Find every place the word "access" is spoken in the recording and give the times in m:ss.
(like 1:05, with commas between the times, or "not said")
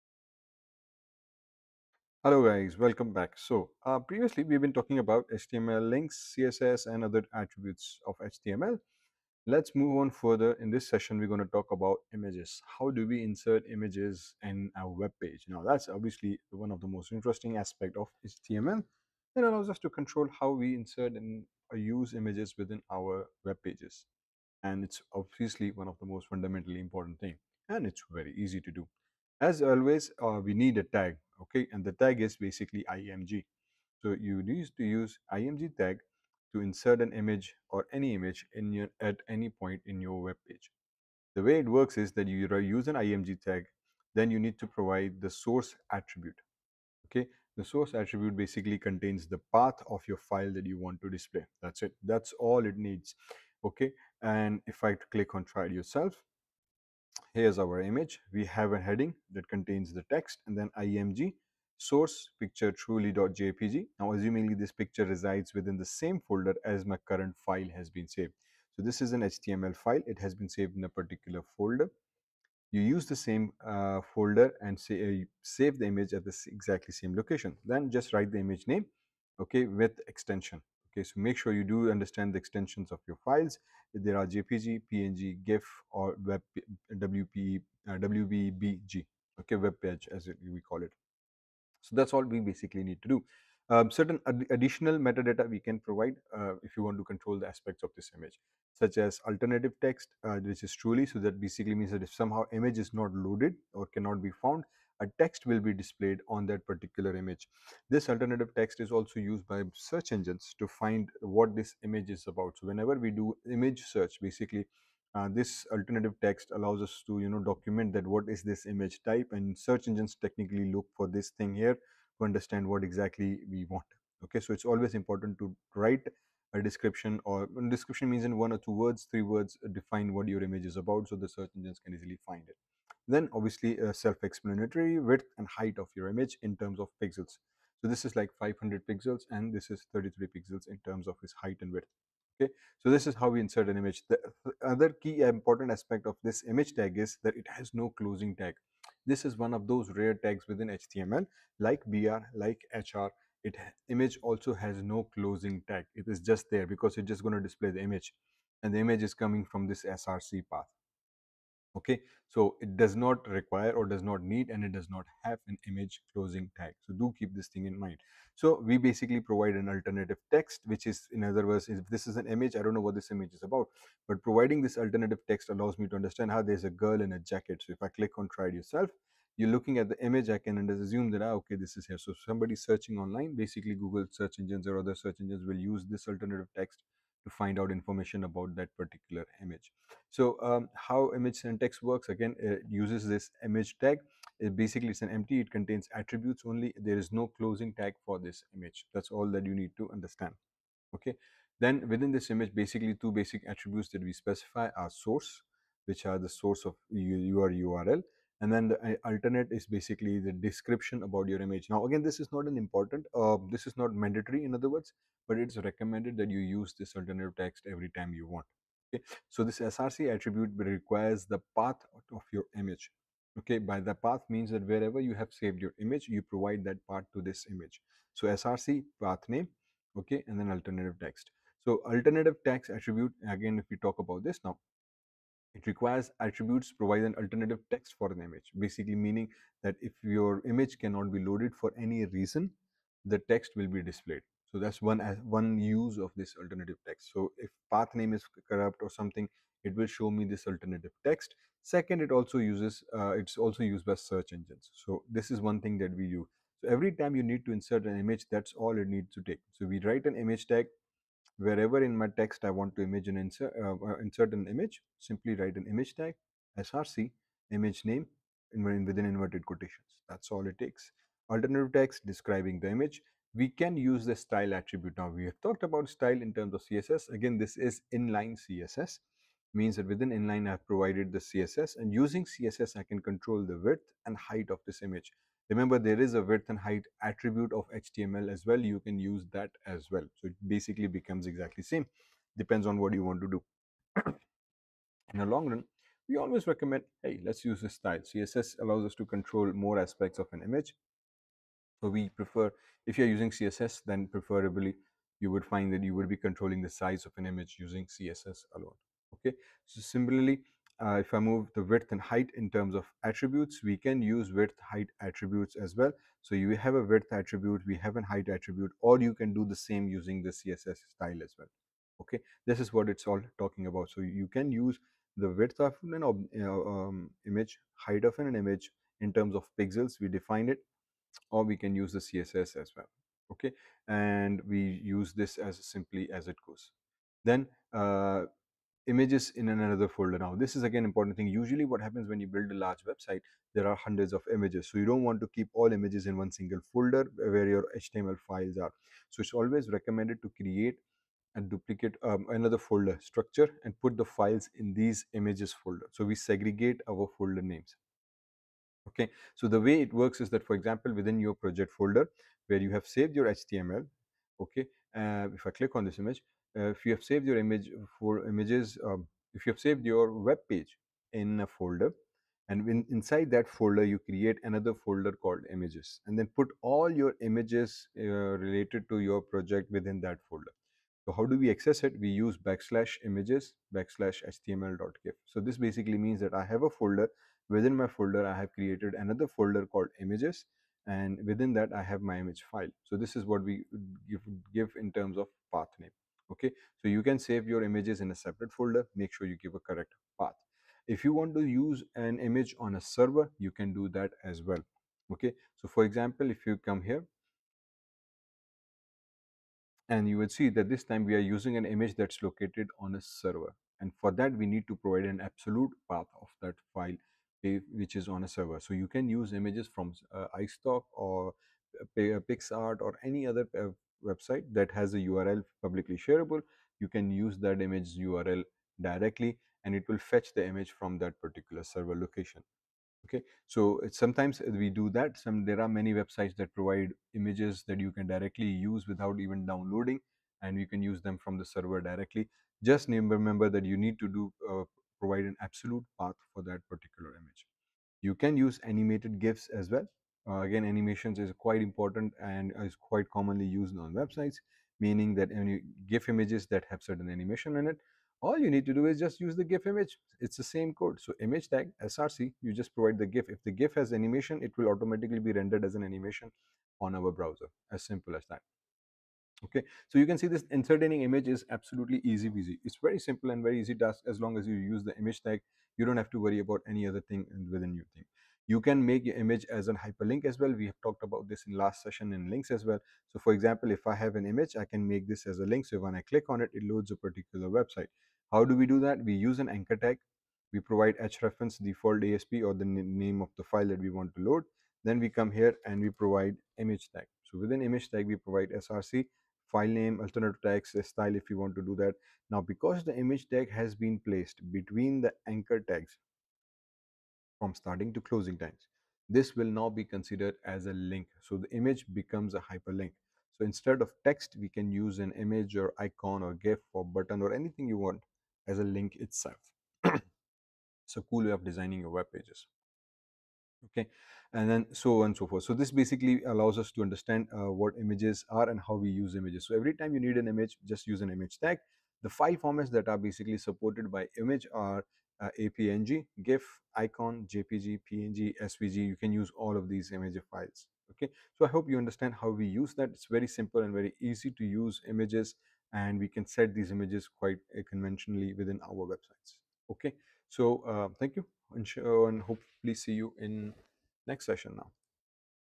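6:21.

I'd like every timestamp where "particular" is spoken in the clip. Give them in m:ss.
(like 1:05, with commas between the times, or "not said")
1:10, 1:46, 3:08, 7:11, 7:26, 8:06.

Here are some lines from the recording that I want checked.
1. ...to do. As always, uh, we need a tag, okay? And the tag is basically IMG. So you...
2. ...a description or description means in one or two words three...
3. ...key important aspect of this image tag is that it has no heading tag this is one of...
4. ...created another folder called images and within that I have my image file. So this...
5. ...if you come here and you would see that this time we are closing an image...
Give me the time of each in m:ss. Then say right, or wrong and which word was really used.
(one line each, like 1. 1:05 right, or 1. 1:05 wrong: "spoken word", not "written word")
1. 0:28 right
2. 2:06 right
3. 2:25 wrong: "closing", not "heading"
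4. 6:28 right
5. 6:46 wrong: "using", not "closing".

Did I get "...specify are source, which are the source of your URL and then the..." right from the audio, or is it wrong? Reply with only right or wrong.
right.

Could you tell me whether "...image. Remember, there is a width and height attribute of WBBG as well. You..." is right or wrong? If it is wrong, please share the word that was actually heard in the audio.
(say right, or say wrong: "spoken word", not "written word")
wrong: "HTML", not "WBBG".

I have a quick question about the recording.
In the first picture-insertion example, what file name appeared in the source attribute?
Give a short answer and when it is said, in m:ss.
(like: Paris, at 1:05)
truly.jpg, at 1:02.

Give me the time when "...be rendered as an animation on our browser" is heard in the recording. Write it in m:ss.
7:45.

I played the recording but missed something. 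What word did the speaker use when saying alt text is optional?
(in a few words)
mandatory.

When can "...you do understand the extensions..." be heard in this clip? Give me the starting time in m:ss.
1:21.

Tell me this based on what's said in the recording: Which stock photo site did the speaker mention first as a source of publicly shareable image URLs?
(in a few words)
iStock.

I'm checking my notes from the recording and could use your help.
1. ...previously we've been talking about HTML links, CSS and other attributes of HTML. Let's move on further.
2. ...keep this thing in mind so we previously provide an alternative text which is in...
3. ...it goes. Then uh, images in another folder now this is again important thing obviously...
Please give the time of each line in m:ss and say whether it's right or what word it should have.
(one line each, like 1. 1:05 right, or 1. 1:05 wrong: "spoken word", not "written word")
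1. 0:03 right
2. 2:47 wrong: "basically", not "previously"
3. 5:36 wrong: "usually", not "obviously".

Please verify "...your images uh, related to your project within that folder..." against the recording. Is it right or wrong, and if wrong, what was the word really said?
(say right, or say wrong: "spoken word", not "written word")
right.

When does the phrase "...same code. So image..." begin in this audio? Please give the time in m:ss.
7:40.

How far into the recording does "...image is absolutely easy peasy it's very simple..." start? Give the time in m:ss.
7:51.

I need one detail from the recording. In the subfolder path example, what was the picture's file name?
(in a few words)
html.gif.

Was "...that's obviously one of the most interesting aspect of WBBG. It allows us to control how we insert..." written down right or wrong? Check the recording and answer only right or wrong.
wrong.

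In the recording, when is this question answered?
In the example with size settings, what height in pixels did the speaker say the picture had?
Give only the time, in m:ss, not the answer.
2:19.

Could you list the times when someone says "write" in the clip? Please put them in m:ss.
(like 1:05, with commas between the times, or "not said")
1:18, 2:05, 4:19, 4:25.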